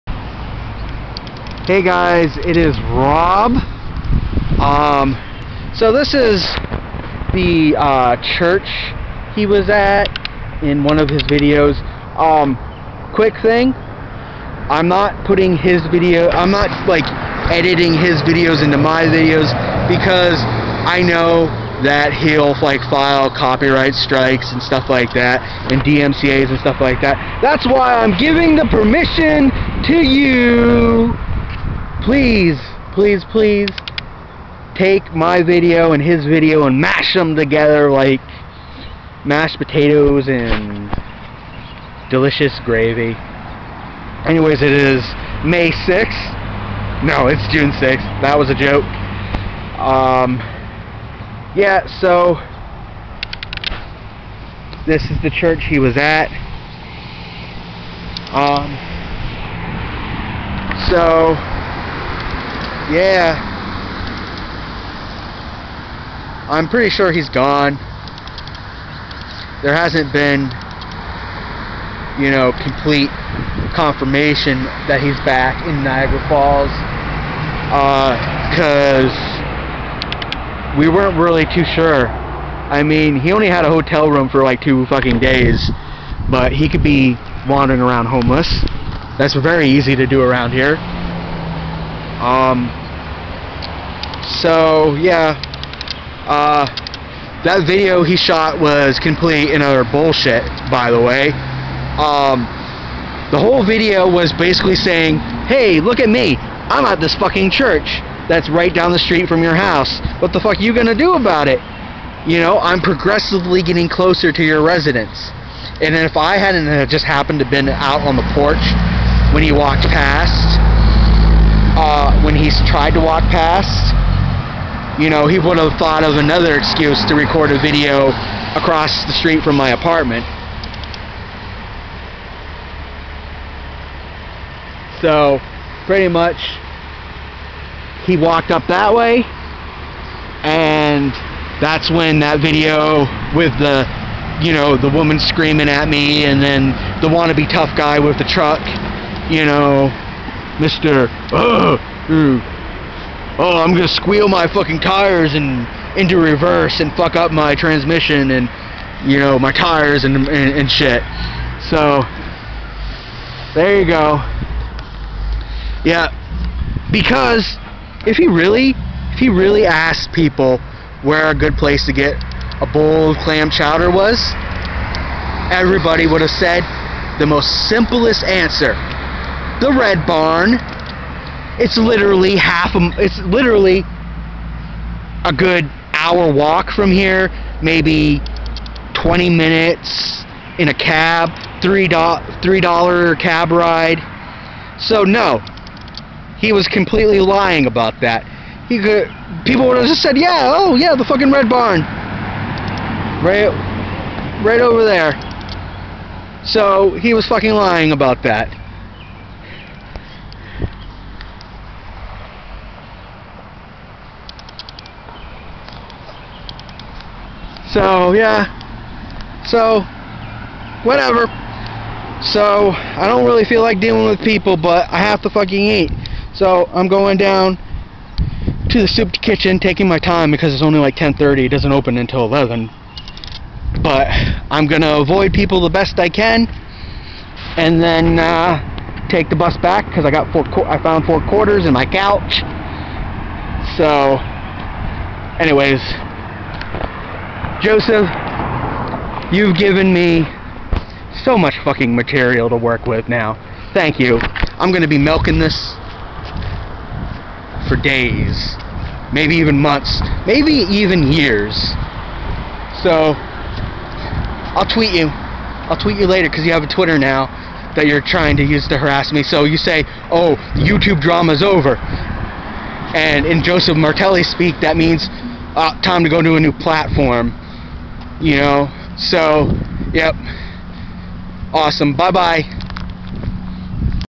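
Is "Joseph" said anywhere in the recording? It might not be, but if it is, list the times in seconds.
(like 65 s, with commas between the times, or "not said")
247 s, 273 s.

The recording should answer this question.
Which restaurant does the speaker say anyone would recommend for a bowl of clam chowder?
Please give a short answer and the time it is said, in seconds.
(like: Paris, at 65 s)
The Red Barn, at 179 s.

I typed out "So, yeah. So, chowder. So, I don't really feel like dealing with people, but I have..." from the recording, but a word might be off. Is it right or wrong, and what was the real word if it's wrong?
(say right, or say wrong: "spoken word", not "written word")
wrong: "whatever", not "chowder".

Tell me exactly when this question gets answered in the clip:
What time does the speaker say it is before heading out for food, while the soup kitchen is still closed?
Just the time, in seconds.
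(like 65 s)
230 s.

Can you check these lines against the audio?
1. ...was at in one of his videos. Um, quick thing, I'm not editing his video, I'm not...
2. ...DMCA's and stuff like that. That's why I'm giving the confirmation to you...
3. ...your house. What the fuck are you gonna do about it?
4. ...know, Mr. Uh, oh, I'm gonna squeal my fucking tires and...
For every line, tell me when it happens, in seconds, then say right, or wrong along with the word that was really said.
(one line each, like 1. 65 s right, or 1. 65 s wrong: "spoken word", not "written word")
1. 9 s wrong: "putting", not "editing"
2. 25 s wrong: "permission", not "confirmation"
3. 109 s right
4. 149 s right.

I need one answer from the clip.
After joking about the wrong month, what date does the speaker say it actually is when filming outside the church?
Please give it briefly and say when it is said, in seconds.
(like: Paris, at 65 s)
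June 6th, at 47 s.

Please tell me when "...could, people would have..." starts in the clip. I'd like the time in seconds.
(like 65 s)
198 s.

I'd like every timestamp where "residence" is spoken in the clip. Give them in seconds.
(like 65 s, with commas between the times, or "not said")
114 s.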